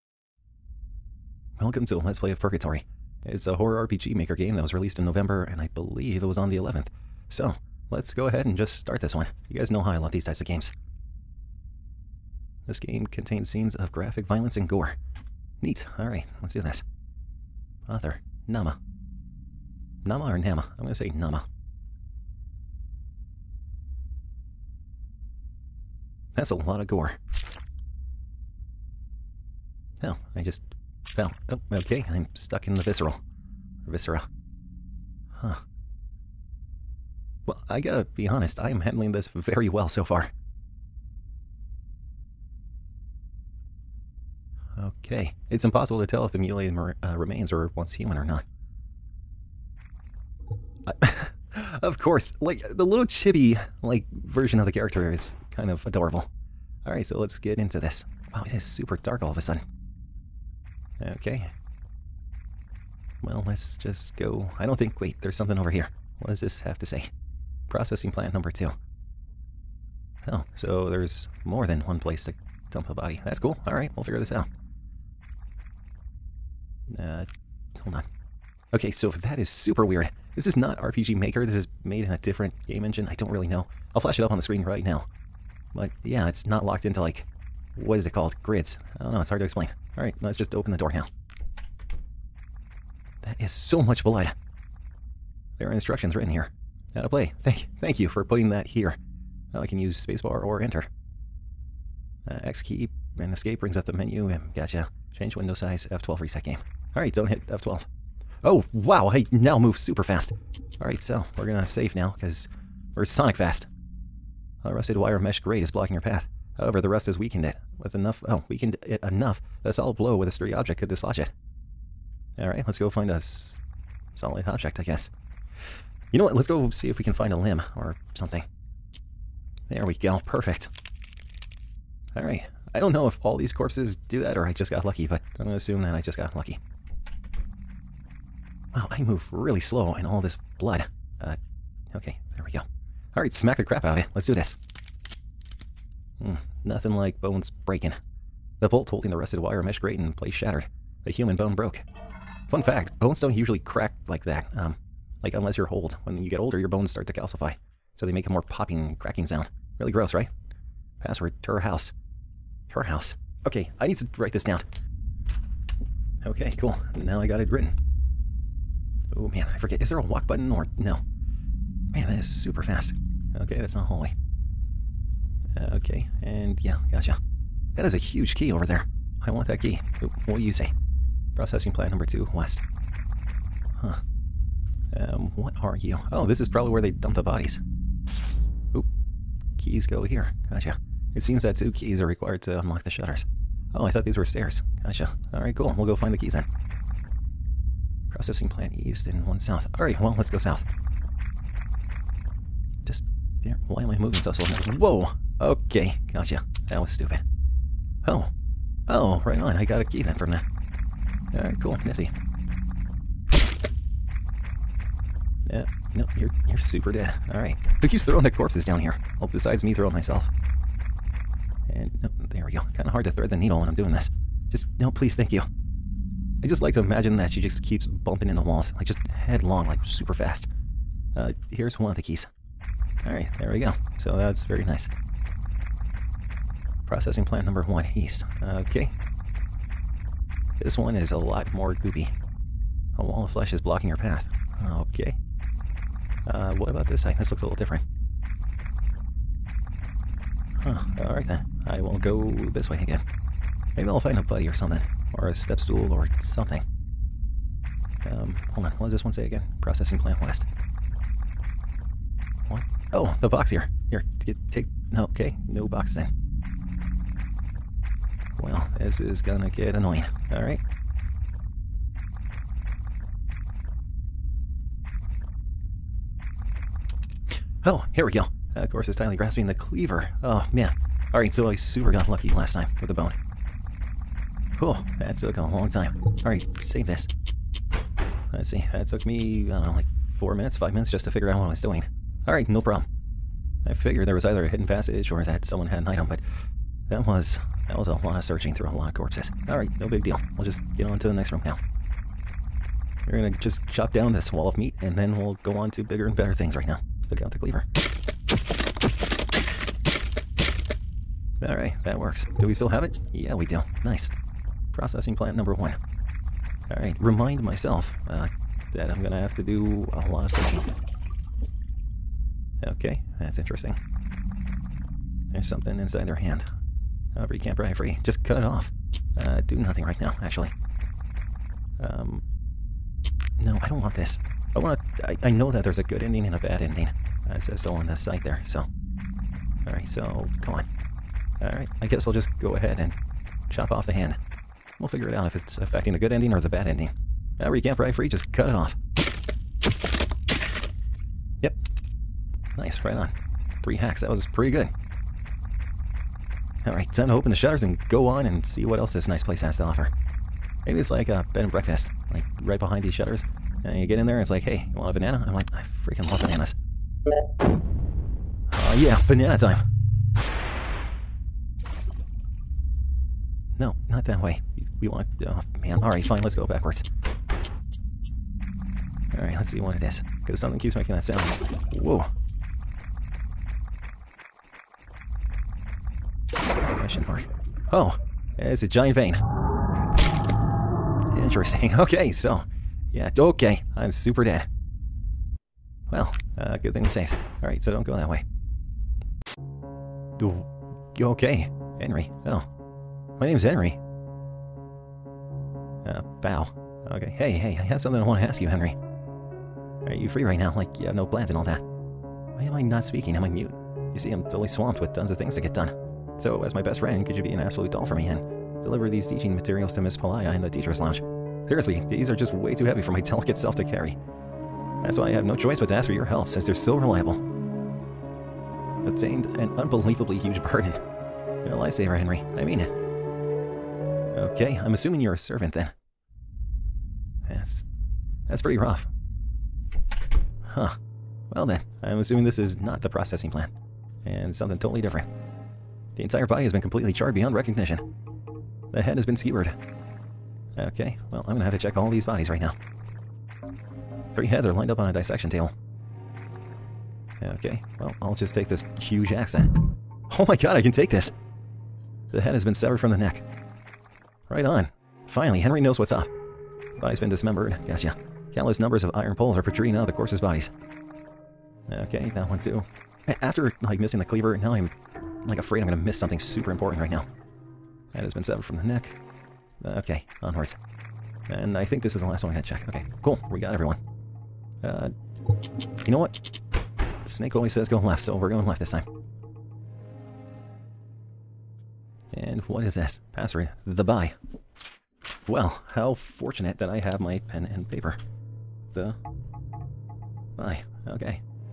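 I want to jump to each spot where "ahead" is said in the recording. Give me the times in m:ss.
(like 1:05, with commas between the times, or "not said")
0:08, 5:42.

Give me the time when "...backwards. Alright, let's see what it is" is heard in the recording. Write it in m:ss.
6:16.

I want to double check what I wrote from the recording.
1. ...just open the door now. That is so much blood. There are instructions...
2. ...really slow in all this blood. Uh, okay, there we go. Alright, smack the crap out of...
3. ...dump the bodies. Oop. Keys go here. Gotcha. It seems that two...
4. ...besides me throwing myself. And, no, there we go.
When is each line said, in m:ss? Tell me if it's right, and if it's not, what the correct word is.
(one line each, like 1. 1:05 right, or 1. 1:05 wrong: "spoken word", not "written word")
1. 1:30 right
2. 2:19 right
3. 3:06 right
4. 3:39 right.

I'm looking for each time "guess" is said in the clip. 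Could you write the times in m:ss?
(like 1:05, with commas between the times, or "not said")
2:04, 5:41.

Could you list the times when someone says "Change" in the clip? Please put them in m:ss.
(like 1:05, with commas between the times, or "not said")
1:45.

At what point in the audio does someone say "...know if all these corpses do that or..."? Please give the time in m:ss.
2:12.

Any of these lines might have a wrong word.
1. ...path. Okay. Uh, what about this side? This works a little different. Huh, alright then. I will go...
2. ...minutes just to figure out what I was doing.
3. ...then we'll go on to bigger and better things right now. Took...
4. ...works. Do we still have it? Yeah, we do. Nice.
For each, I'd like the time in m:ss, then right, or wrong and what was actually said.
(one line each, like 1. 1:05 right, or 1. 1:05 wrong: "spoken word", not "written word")
1. 4:03 wrong: "looks", not "works"
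2. 4:50 right
3. 5:04 right
4. 5:11 right.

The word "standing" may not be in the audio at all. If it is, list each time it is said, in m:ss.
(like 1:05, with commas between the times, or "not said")
not said.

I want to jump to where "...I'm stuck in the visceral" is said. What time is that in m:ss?
0:32.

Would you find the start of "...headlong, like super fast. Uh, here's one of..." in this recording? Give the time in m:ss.
3:49.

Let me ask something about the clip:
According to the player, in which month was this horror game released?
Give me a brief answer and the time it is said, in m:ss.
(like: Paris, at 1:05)
November, at 0:05.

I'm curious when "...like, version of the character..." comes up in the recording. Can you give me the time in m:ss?
0:53.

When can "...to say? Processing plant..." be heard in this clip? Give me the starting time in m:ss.
1:06.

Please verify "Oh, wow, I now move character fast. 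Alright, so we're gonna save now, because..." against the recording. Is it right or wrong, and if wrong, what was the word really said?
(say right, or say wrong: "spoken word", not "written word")
wrong: "super", not "character".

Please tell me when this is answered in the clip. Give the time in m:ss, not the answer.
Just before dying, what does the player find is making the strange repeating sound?
6:28.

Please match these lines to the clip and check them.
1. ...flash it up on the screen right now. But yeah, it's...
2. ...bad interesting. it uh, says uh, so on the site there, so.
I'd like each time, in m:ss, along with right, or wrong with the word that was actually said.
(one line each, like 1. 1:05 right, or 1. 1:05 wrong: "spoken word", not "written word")
1. 1:23 right
2. 5:36 wrong: "ending", not "interesting".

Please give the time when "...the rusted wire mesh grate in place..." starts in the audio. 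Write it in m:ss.
2:29.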